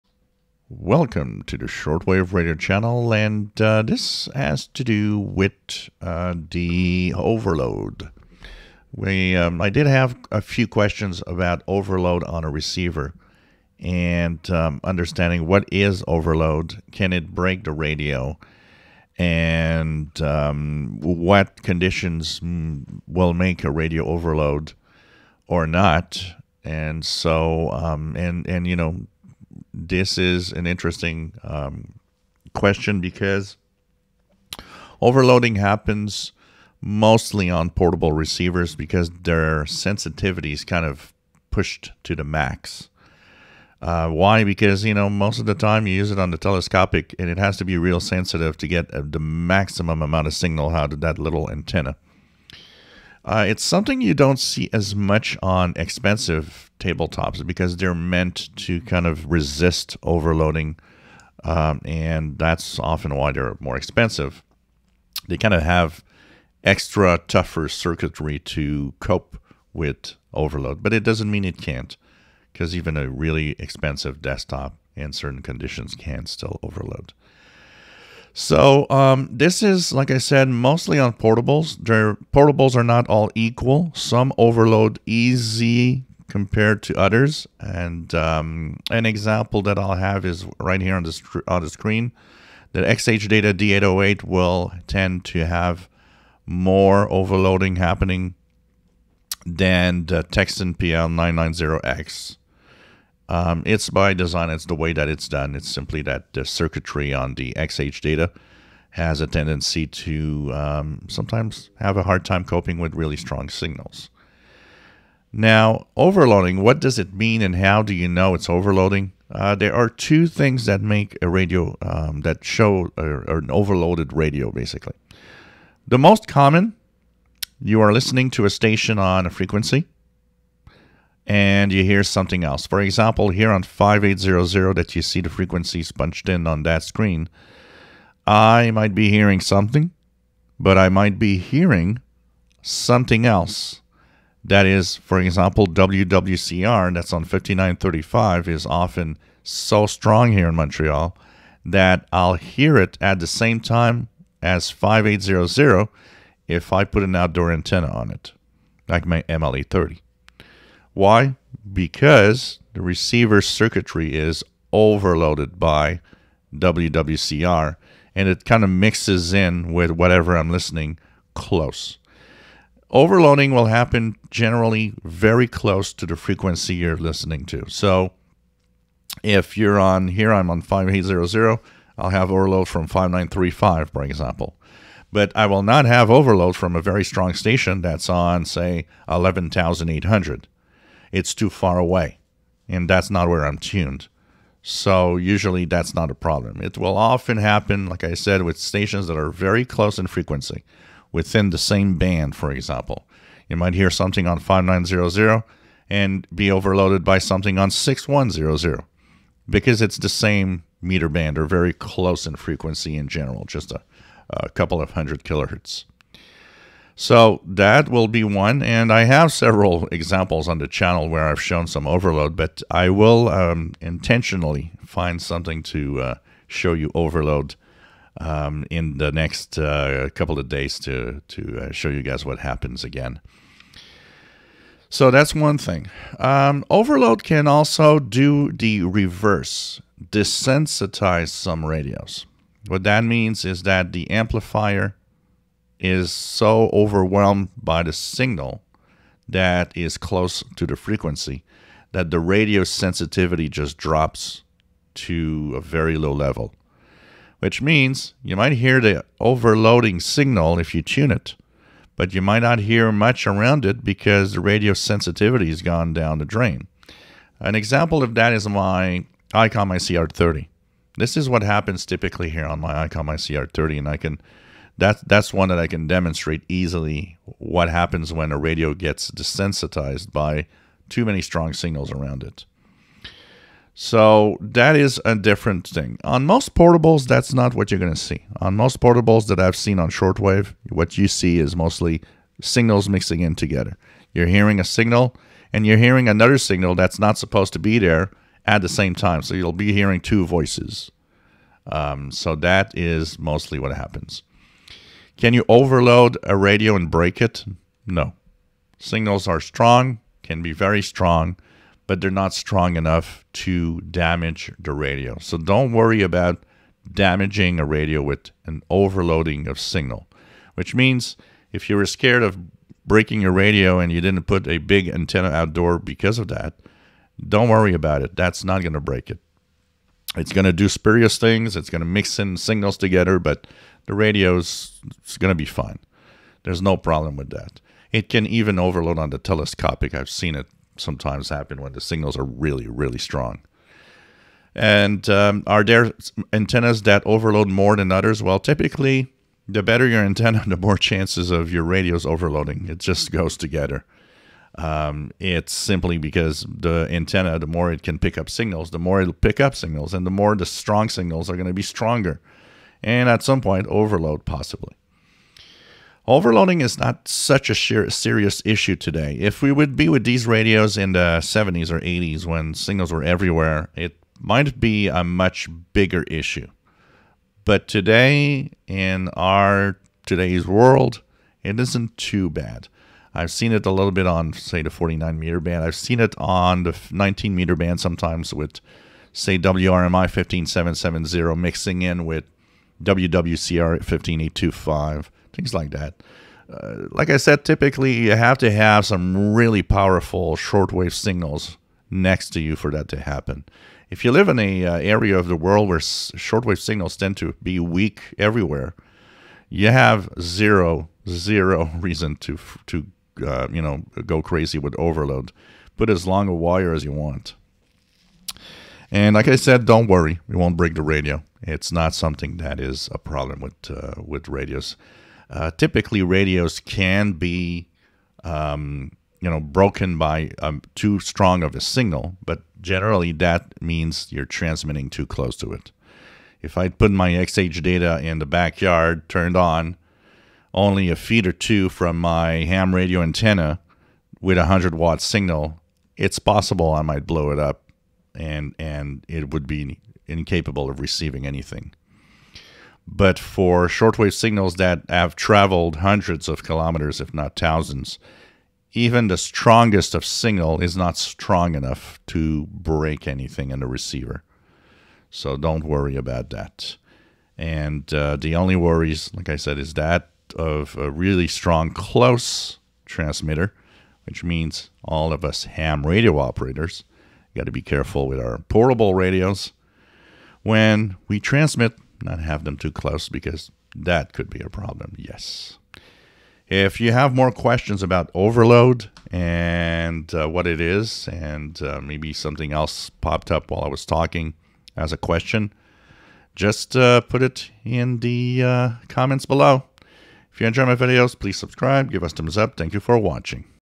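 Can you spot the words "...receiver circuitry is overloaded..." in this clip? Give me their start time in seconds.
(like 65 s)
162 s.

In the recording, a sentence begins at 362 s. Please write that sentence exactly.
And at some point, overload possibly.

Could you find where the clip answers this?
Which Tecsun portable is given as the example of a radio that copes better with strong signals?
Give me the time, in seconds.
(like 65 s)
100 s.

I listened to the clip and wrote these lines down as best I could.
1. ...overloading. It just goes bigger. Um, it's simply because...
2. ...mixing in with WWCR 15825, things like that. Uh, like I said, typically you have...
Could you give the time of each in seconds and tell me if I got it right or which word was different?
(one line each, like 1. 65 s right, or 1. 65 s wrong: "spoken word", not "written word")
1. 352 s wrong: "together", not "bigger"
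2. 391 s right.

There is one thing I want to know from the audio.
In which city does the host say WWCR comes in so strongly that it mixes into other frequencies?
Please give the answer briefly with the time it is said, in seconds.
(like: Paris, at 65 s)
Montreal, at 150 s.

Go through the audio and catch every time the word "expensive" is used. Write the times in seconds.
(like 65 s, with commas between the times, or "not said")
55 s, 63 s, 73 s.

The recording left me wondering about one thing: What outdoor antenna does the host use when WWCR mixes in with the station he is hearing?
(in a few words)
MLA 30.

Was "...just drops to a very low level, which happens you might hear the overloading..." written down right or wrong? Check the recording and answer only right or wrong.
wrong.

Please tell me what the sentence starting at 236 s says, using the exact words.
Um, overload can also do the reverse, desensitize some radios.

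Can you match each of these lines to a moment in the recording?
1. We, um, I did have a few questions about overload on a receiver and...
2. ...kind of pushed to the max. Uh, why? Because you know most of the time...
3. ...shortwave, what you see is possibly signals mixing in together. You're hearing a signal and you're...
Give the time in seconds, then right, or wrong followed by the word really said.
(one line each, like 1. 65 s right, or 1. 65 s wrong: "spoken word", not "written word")
1. 8 s right
2. 40 s right
3. 289 s wrong: "mostly", not "possibly".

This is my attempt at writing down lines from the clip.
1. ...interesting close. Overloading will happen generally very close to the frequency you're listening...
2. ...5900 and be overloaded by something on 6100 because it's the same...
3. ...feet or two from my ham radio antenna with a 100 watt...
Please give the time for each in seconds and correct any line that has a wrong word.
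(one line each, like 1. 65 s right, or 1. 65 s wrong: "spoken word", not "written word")
1. 170 s wrong: "listening", not "interesting"
2. 204 s right
3. 440 s right.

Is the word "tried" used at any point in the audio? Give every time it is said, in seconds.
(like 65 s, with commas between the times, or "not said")
not said.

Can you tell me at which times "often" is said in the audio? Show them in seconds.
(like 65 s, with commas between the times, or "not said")
62 s, 148 s, 196 s.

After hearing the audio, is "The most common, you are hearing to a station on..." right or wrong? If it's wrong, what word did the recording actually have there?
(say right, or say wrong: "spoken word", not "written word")
wrong: "listening", not "hearing".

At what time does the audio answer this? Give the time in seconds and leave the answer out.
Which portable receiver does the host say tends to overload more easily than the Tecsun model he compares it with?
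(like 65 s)
92 s.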